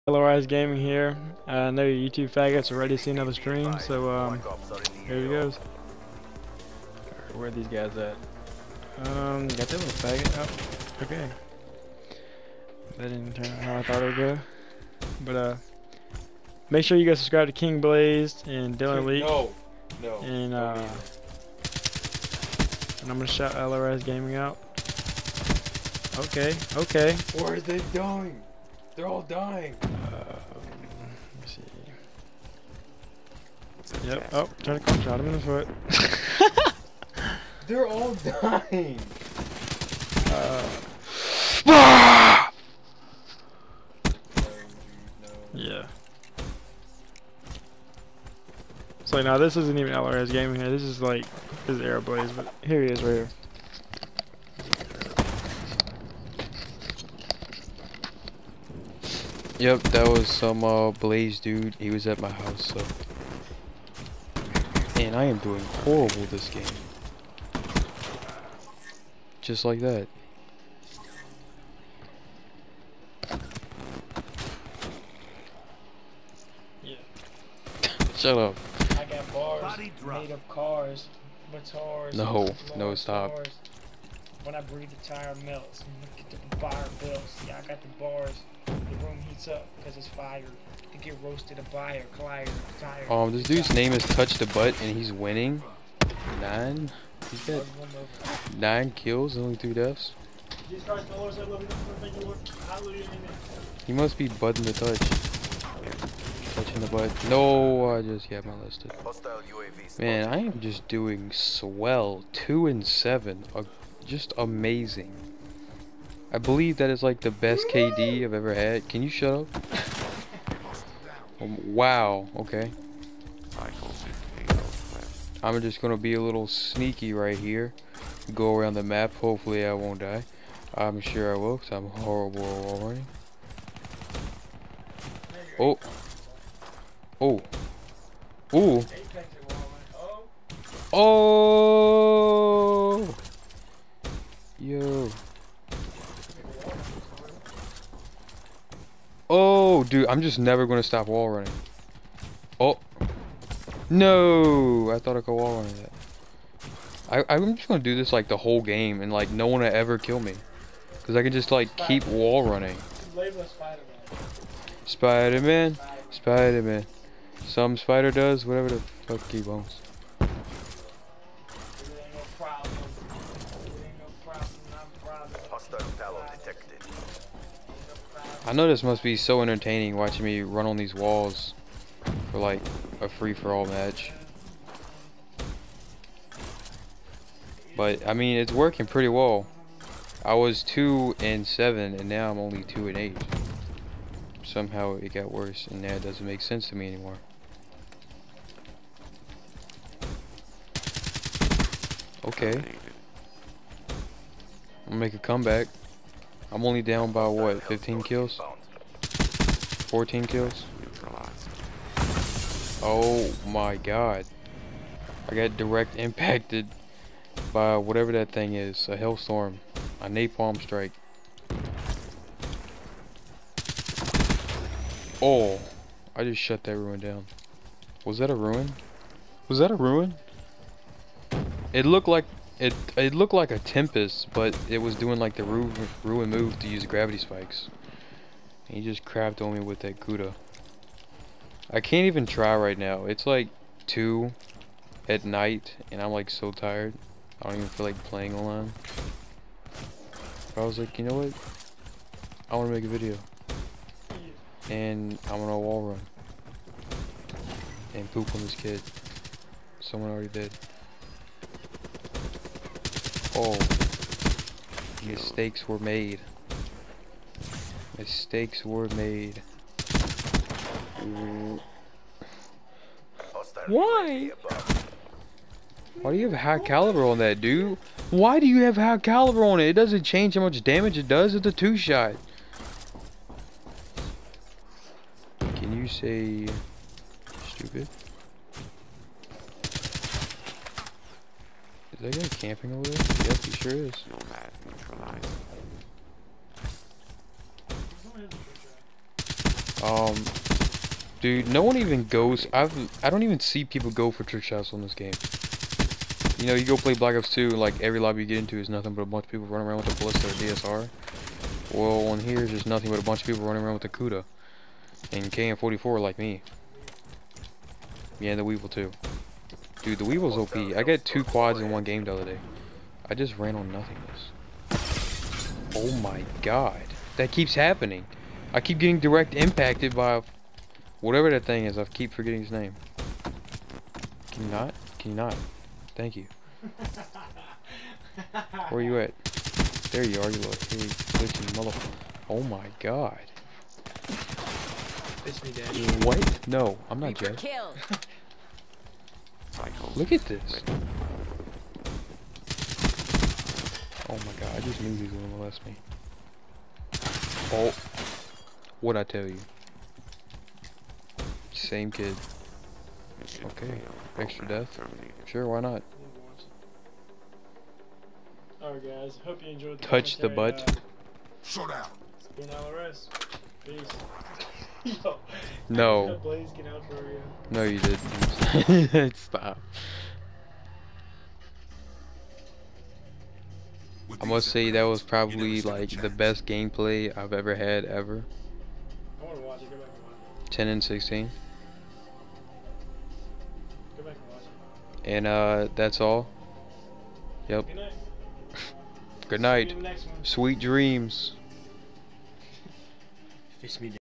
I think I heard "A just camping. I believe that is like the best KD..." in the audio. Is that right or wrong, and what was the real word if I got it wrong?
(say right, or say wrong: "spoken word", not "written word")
wrong: "amazing", not "camping".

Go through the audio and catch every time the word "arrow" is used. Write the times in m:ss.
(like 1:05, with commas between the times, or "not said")
0:51.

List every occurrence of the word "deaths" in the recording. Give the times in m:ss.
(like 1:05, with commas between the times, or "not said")
1:39, 6:04.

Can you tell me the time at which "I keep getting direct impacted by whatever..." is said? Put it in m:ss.
5:28.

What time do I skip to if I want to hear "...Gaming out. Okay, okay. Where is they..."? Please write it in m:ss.
0:24.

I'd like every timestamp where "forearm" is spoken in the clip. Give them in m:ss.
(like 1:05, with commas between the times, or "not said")
not said.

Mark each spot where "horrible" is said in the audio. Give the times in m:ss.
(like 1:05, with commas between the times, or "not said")
1:05, 2:11.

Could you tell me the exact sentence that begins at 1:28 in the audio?
The room heats up because it's fire.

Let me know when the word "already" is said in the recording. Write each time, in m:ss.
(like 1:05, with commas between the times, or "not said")
2:12, 4:20.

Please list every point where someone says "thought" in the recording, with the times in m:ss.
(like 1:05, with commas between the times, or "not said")
0:13, 2:34.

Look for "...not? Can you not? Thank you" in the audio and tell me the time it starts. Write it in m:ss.
5:34.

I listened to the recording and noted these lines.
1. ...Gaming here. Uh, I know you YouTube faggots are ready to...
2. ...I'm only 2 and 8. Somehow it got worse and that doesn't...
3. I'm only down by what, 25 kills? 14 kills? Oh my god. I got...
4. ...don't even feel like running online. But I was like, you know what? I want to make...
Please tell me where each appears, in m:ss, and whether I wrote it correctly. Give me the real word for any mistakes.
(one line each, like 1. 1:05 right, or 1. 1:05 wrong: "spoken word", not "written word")
1. 0:00 right
2. 3:12 right
3. 3:26 wrong: "15", not "25"
4. 4:07 wrong: "playing", not "running".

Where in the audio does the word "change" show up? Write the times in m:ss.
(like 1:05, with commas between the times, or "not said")
4:40.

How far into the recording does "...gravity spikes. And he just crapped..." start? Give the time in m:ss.
3:56.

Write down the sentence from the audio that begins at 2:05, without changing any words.
I'm just gonna be a little sneaky right here.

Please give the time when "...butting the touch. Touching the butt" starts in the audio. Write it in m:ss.
1:44.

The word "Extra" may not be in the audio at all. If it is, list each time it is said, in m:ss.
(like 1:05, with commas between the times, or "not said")
6:04.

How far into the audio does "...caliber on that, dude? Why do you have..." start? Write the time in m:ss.
4:36.